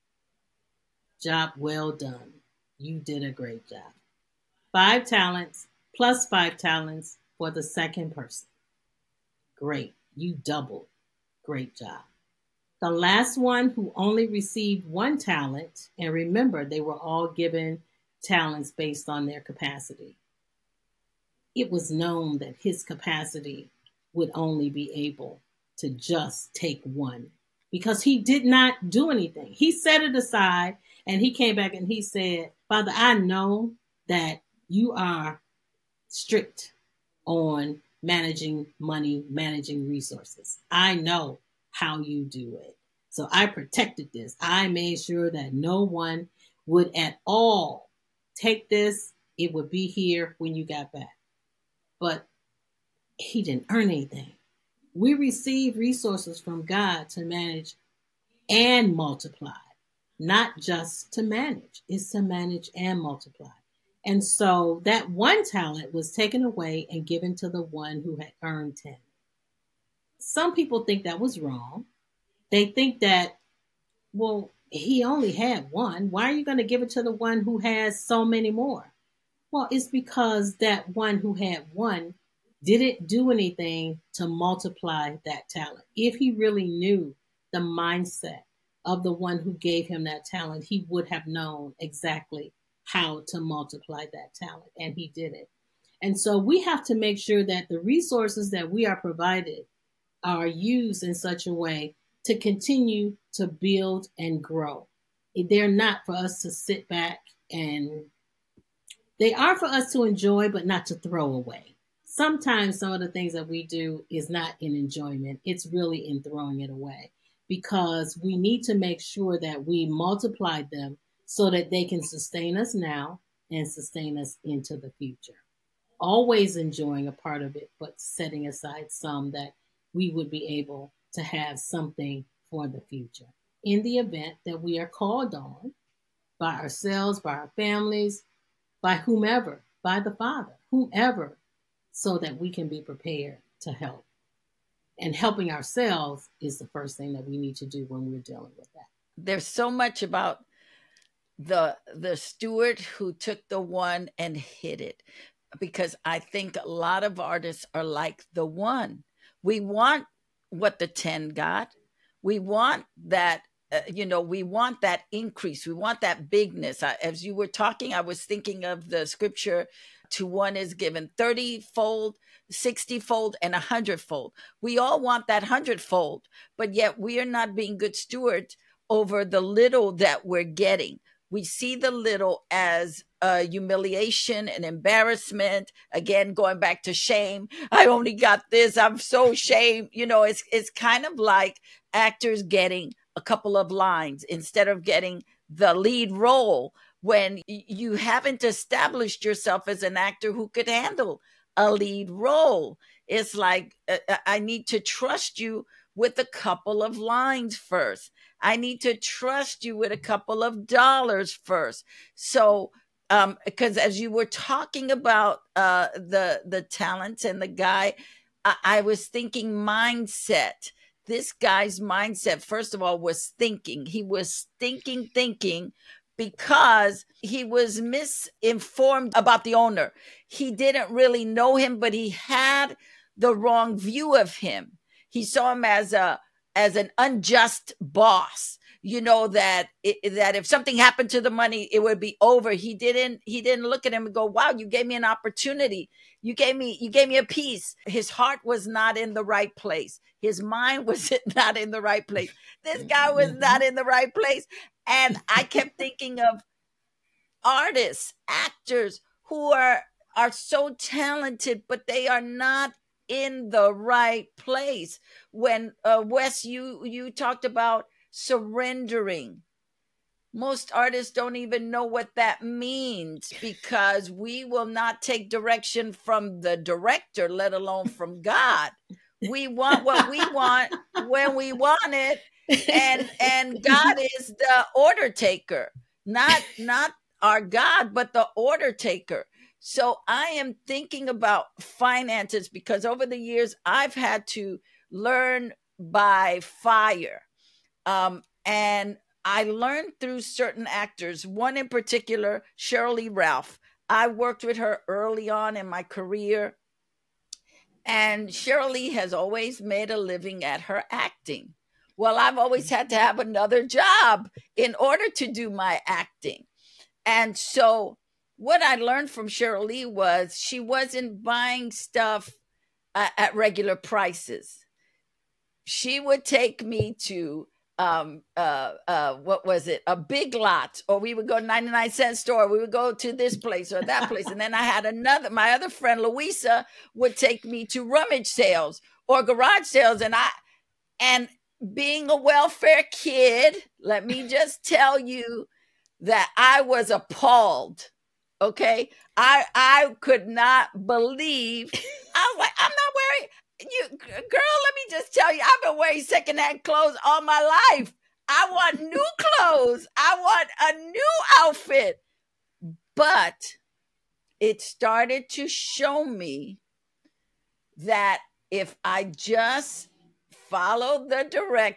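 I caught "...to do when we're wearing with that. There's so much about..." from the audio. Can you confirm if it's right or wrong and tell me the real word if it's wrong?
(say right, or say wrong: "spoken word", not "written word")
wrong: "dealing", not "wearing".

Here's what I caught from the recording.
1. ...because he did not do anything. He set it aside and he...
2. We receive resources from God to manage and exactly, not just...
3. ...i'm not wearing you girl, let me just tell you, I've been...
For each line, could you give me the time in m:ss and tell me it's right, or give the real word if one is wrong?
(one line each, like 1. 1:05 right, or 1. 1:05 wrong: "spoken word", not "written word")
1. 0:27 right
2. 0:54 wrong: "multiply", not "exactly"
3. 5:52 right.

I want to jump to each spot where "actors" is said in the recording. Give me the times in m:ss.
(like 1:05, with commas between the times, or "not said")
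3:11, 3:19, 4:18, 5:00.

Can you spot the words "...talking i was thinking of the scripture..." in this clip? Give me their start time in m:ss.
2:47.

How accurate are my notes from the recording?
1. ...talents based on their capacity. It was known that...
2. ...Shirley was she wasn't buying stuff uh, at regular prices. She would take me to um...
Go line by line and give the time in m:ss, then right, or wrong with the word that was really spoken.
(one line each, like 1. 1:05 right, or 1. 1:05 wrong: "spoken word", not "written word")
1. 0:18 right
2. 5:19 right.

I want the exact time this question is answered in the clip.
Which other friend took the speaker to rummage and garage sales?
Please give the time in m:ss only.
5:36.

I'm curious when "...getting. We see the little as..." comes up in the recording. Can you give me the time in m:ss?
3:00.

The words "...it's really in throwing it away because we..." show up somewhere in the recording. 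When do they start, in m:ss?
1:55.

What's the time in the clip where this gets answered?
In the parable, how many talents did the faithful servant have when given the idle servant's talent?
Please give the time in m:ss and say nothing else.
1:08.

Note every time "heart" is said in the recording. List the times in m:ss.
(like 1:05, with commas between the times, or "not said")
4:08.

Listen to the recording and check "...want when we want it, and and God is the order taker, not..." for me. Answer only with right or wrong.
right.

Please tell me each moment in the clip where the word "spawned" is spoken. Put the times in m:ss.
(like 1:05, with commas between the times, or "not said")
not said.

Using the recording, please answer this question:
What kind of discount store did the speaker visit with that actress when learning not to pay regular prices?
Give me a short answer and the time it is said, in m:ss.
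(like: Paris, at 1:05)
99 cent store, at 5:31.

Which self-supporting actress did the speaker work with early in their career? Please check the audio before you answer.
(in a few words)
Sheryl Lee Ralph.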